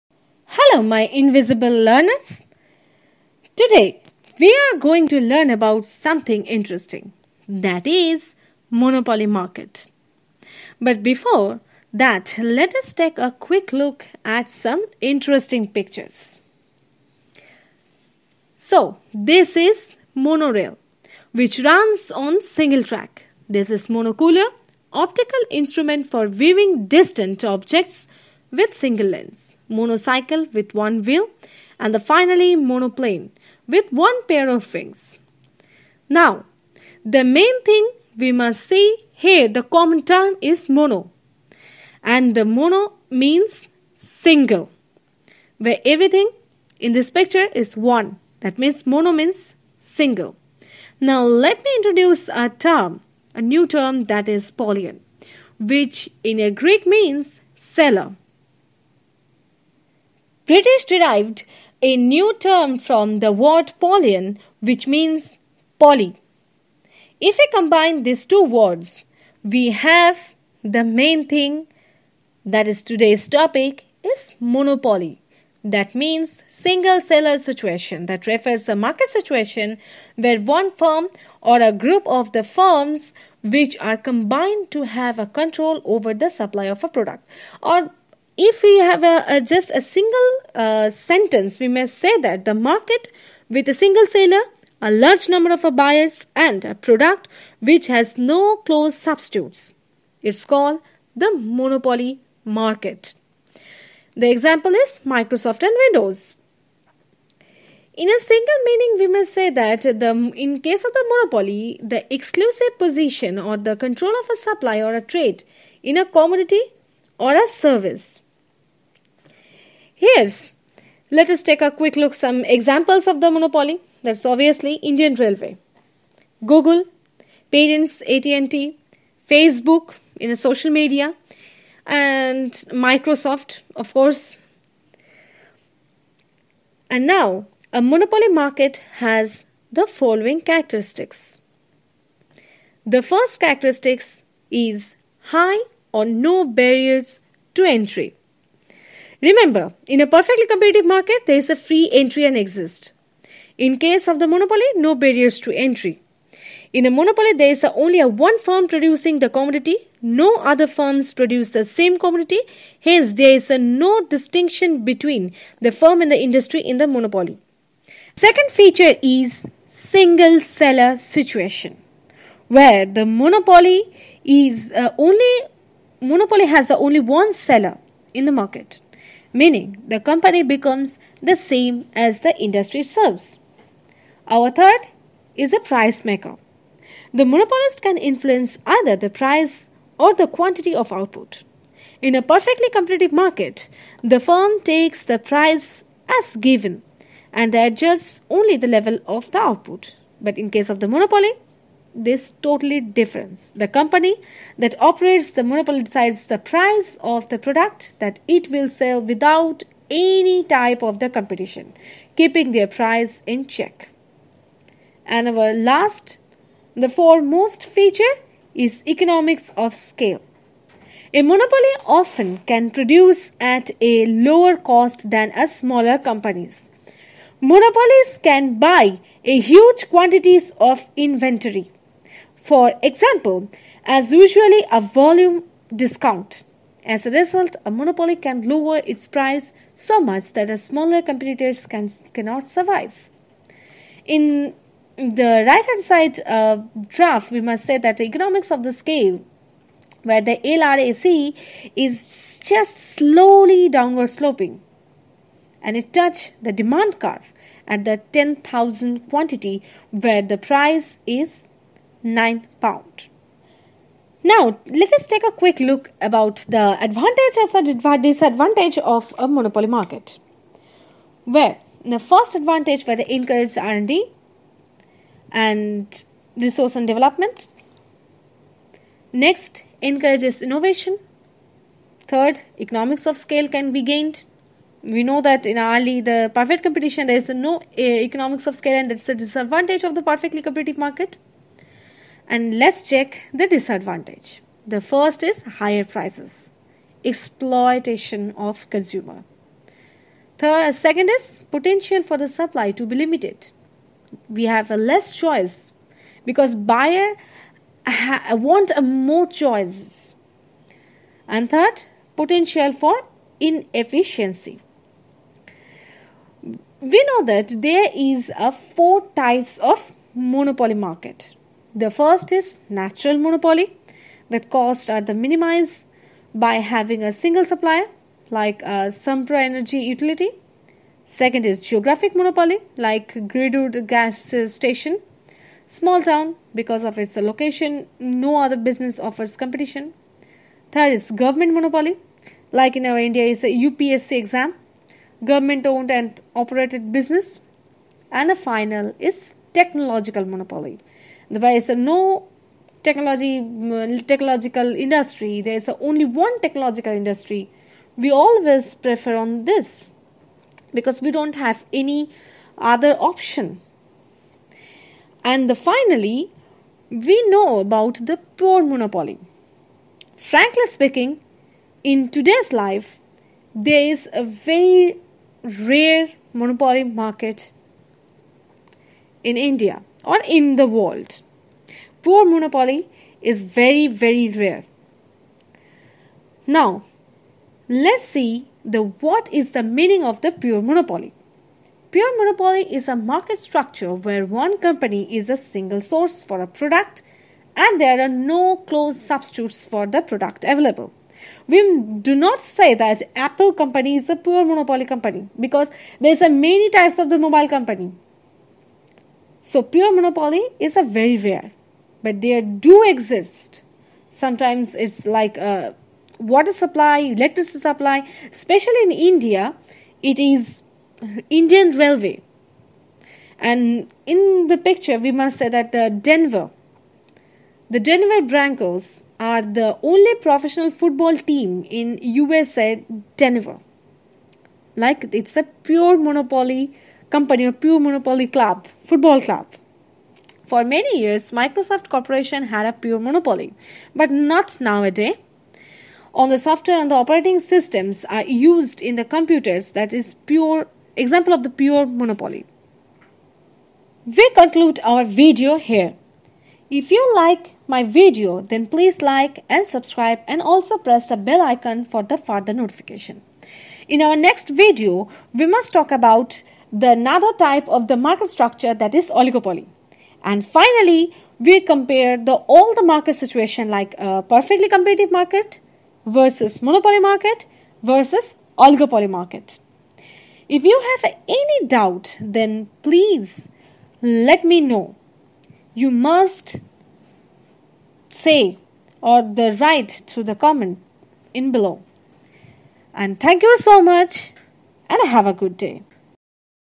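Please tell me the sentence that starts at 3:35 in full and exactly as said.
And our last, the foremost feature is economics of scale.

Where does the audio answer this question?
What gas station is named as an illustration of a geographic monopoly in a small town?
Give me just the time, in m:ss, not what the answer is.
5:33.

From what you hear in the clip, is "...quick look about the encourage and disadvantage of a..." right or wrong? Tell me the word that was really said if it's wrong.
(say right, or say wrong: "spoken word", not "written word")
wrong: "advantage", not "encourage".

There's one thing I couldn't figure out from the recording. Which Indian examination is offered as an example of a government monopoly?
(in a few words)
UPSC exam.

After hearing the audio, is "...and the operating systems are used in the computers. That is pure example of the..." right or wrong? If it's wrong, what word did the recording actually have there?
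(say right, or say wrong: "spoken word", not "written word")
right.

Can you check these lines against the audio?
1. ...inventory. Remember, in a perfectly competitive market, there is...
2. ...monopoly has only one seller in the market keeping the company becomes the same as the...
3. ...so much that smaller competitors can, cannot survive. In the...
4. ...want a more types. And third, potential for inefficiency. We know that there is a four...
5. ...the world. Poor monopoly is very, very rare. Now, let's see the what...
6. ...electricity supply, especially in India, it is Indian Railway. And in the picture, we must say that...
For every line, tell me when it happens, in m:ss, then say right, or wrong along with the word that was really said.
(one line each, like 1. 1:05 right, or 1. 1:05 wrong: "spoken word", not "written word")
1. 2:27 wrong: "entry", not "inventory"
2. 2:56 wrong: "meaning", not "keeping"
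3. 3:59 right
4. 5:08 wrong: "choices", not "types"
5. 6:20 right
6. 6:56 right.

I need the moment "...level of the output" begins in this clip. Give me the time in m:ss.
3:18.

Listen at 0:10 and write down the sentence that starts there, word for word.
But before that, let us take a quick look at some interesting pictures.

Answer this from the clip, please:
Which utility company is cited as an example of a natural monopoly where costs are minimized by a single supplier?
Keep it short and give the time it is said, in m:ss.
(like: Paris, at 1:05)
Sempra Energy, at 5:28.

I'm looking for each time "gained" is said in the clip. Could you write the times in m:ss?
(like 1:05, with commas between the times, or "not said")
4:43.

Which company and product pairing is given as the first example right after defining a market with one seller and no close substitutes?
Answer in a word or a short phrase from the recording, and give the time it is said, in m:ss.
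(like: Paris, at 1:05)
Microsoft and Windows, at 1:45.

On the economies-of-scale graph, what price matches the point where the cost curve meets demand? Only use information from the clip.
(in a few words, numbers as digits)
£9.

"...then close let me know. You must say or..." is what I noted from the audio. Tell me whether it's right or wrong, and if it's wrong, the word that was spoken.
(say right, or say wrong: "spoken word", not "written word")
wrong: "please", not "close".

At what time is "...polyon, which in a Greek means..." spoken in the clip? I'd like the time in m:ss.
0:54.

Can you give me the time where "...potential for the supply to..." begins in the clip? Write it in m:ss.
5:01.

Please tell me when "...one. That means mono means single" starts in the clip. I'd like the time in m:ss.
0:47.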